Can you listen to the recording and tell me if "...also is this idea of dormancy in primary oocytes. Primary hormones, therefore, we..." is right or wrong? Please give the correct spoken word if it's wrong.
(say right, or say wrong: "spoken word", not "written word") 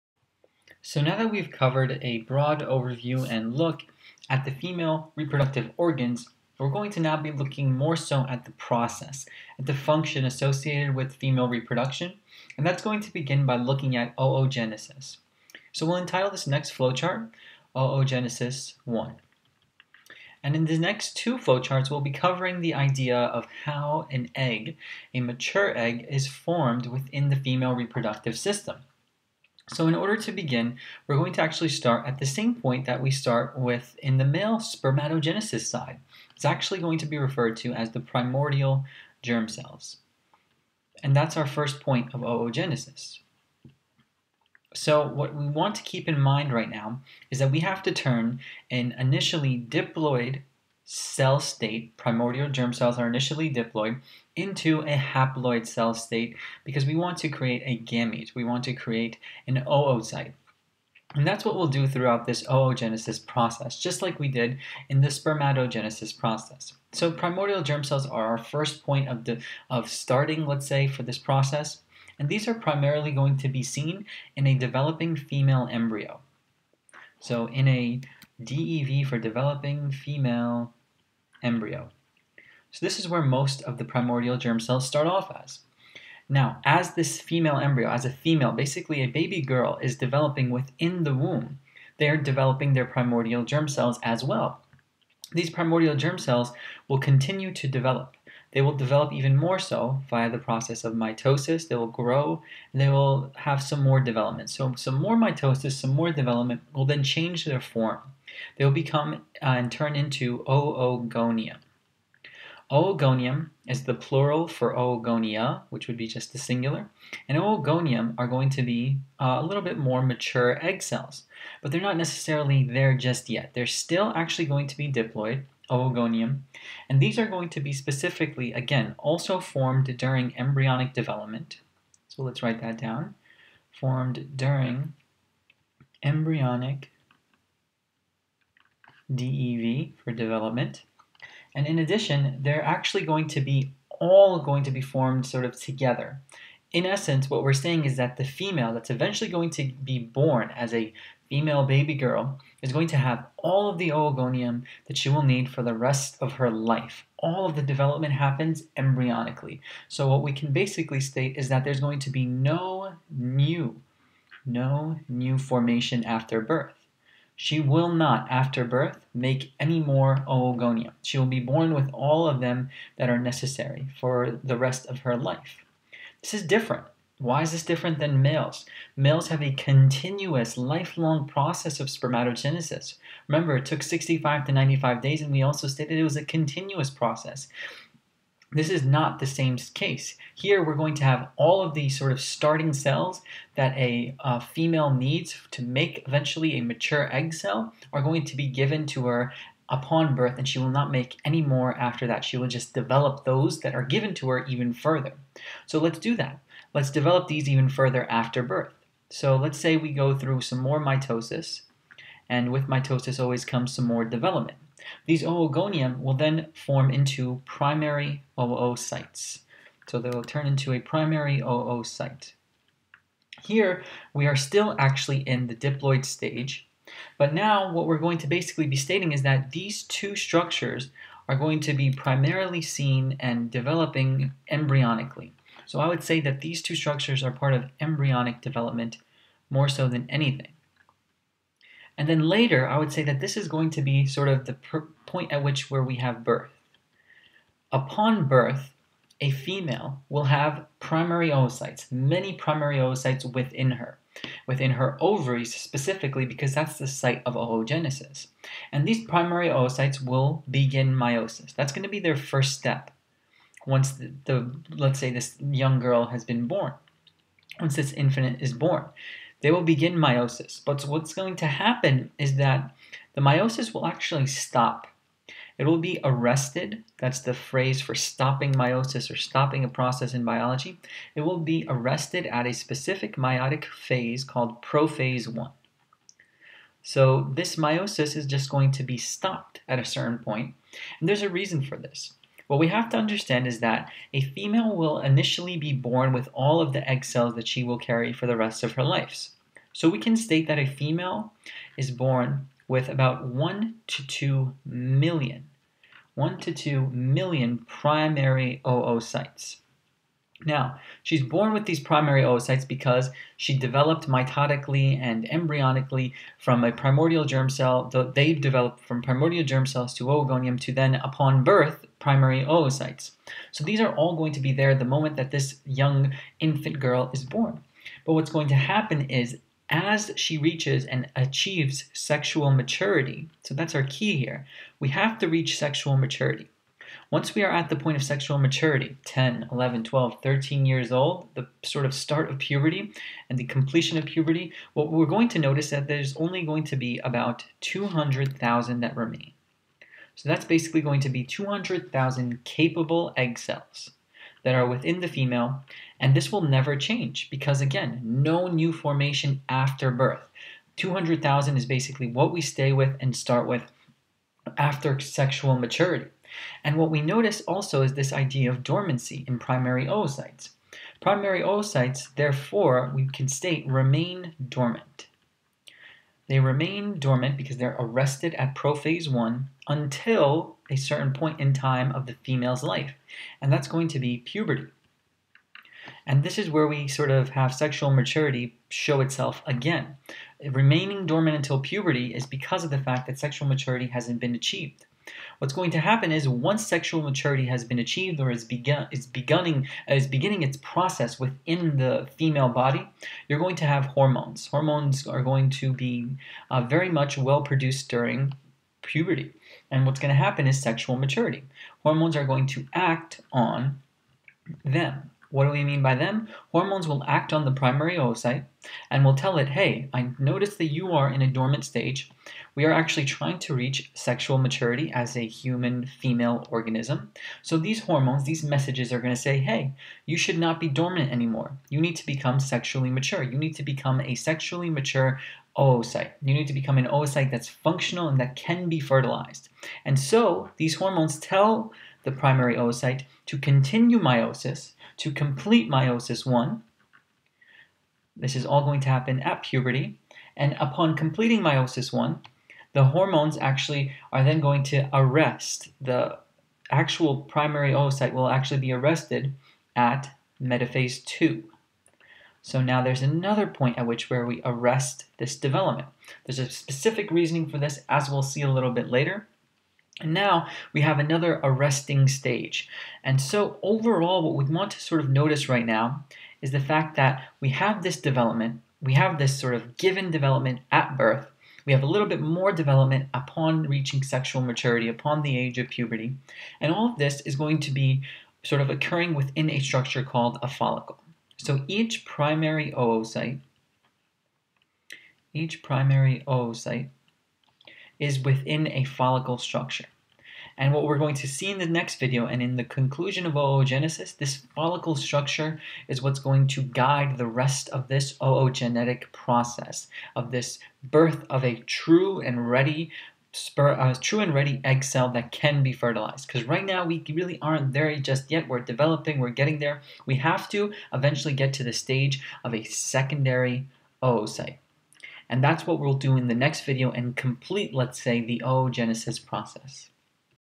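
wrong: "oocytes", not "hormones".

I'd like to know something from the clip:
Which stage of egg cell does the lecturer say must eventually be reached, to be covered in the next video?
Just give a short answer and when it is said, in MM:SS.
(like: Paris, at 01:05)
secondary oocyte, at 08:42.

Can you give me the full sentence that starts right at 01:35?
These primordial germ cells will continue to develop.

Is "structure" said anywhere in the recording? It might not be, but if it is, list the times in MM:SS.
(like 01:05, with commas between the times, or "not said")
03:50, 03:56, 08:09, 08:19, 08:24.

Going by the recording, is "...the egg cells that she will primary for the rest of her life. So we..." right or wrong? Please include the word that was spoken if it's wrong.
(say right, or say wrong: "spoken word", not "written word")
wrong: "carry", not "primary".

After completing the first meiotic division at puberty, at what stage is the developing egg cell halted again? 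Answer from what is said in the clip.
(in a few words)
metaphase two.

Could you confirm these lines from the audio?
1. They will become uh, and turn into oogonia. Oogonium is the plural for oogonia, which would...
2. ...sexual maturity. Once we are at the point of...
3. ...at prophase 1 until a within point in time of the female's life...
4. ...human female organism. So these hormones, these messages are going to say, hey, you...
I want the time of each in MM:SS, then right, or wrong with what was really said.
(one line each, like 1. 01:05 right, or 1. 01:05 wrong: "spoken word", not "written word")
1. 01:48 right
2. 05:35 right
3. 06:18 wrong: "certain", not "within"
4. 07:05 right.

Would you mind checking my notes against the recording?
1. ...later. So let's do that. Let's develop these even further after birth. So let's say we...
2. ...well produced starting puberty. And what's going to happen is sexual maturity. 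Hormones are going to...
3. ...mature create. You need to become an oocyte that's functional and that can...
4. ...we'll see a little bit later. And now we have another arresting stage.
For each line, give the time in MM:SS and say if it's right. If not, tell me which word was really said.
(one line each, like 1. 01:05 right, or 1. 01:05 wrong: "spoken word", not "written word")
1. 03:24 wrong: "further", not "later"
2. 06:47 wrong: "during", not "starting"
3. 07:14 wrong: "oocyte", not "create"
4. 07:48 right.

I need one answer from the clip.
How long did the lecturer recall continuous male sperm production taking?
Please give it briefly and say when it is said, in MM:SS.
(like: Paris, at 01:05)
65 to 95 days, at 03:03.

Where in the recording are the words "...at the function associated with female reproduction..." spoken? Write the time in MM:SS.
00:09.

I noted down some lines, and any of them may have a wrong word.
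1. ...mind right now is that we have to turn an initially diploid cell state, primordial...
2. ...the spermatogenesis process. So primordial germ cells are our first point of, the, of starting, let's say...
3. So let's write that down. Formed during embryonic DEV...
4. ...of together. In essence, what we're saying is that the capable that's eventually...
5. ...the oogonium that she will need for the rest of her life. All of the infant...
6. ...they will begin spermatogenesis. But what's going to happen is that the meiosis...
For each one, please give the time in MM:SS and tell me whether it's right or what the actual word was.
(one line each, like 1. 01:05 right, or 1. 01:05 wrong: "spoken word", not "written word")
1. 00:46 right
2. 01:05 right
3. 02:12 right
4. 02:25 wrong: "female", not "capable"
5. 02:33 wrong: "development", not "infant"
6. 04:29 wrong: "meiosis", not "spermatogenesis".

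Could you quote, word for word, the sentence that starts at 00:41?
And that's our first point of oogenesis.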